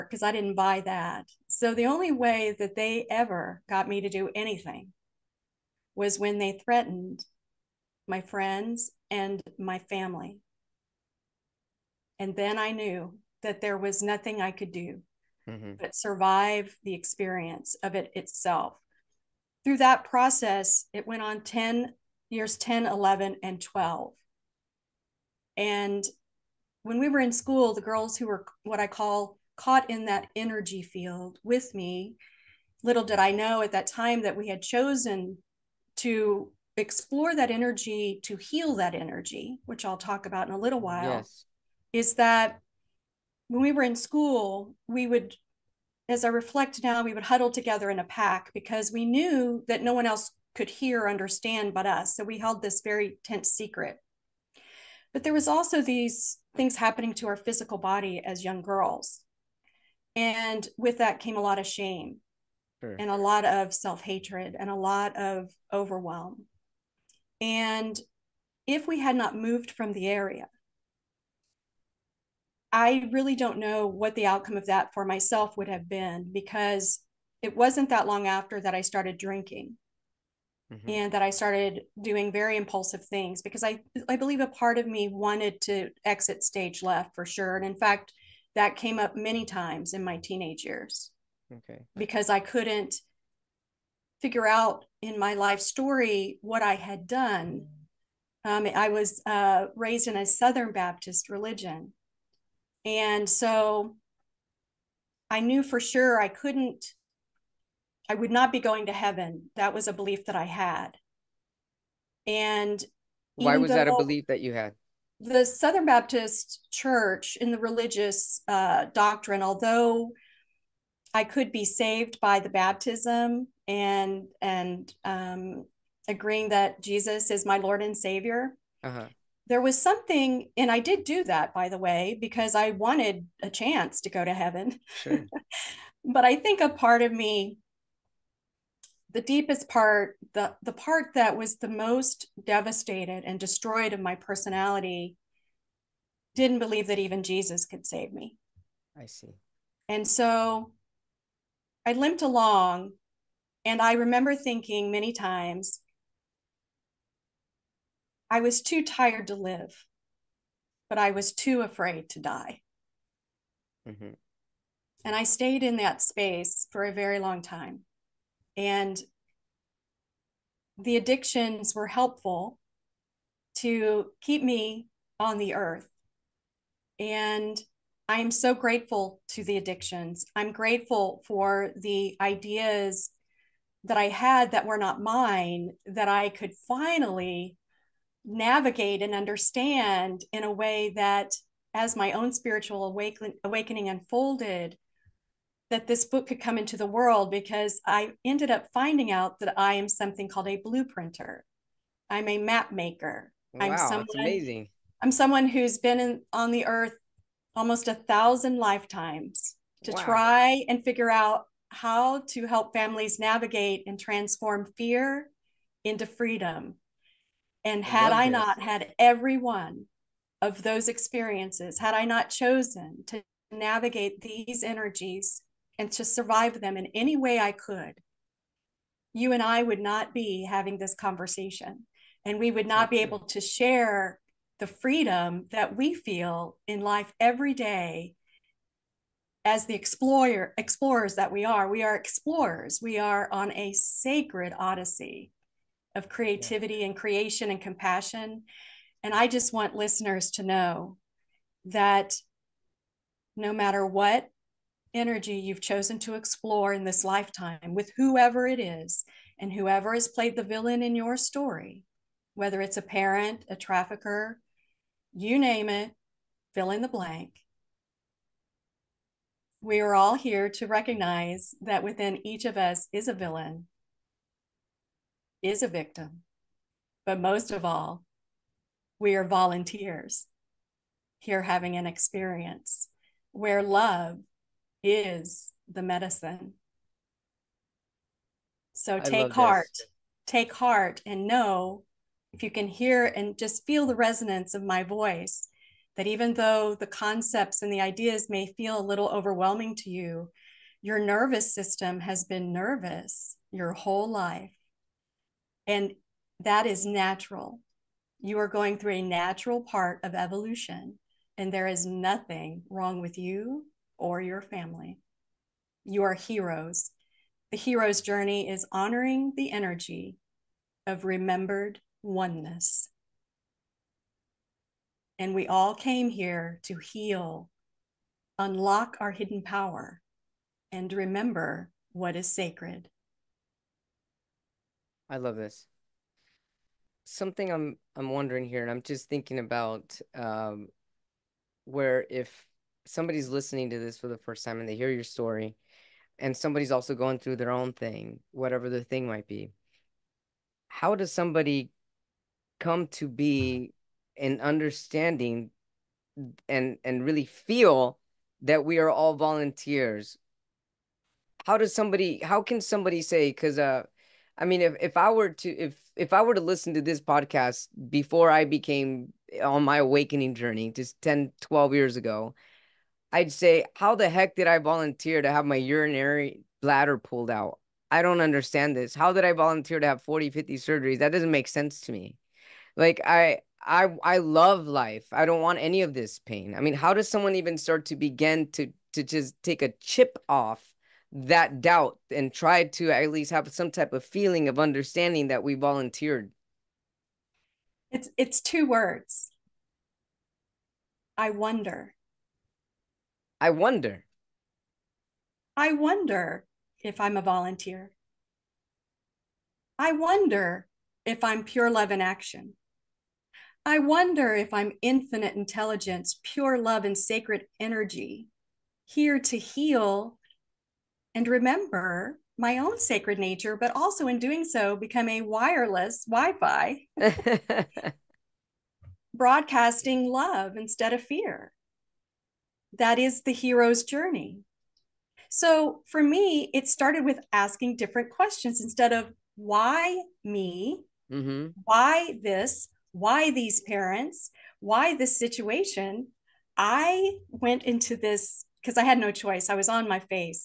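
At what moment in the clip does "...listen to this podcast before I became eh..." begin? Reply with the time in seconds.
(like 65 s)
366 s.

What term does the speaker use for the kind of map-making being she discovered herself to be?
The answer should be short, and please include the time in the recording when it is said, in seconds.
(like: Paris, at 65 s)
Blueprinter, at 200 s.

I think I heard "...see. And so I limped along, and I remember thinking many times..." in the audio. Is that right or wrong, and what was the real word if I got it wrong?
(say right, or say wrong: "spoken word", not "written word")
right.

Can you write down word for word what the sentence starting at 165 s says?
And I stayed in that space for a very long time.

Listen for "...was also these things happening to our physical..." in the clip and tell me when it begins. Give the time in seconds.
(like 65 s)
55 s.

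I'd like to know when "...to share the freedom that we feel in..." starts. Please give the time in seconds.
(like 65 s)
233 s.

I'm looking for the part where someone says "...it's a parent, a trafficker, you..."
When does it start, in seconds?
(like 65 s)
262 s.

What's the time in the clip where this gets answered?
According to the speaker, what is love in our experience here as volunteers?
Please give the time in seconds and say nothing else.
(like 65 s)
285 s.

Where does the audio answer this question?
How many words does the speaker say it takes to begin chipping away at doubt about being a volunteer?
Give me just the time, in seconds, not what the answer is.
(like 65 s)
398 s.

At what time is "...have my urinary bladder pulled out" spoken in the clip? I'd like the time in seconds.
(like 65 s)
375 s.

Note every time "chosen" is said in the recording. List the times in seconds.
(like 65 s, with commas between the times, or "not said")
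34 s, 222 s, 255 s.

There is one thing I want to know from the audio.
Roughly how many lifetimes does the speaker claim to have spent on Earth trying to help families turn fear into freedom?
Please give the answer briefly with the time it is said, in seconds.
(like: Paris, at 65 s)
1000, at 207 s.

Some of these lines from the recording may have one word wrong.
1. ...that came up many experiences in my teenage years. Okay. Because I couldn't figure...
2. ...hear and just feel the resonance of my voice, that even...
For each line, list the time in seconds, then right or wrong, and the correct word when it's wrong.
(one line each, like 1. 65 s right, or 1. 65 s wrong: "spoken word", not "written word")
1. 88 s wrong: "times", not "experiences"
2. 292 s right.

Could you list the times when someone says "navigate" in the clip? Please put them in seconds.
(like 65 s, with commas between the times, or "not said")
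188 s, 213 s, 223 s.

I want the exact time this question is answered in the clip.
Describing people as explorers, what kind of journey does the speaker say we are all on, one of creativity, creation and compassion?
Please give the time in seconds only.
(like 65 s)
243 s.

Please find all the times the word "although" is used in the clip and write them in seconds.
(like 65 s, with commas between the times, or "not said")
119 s.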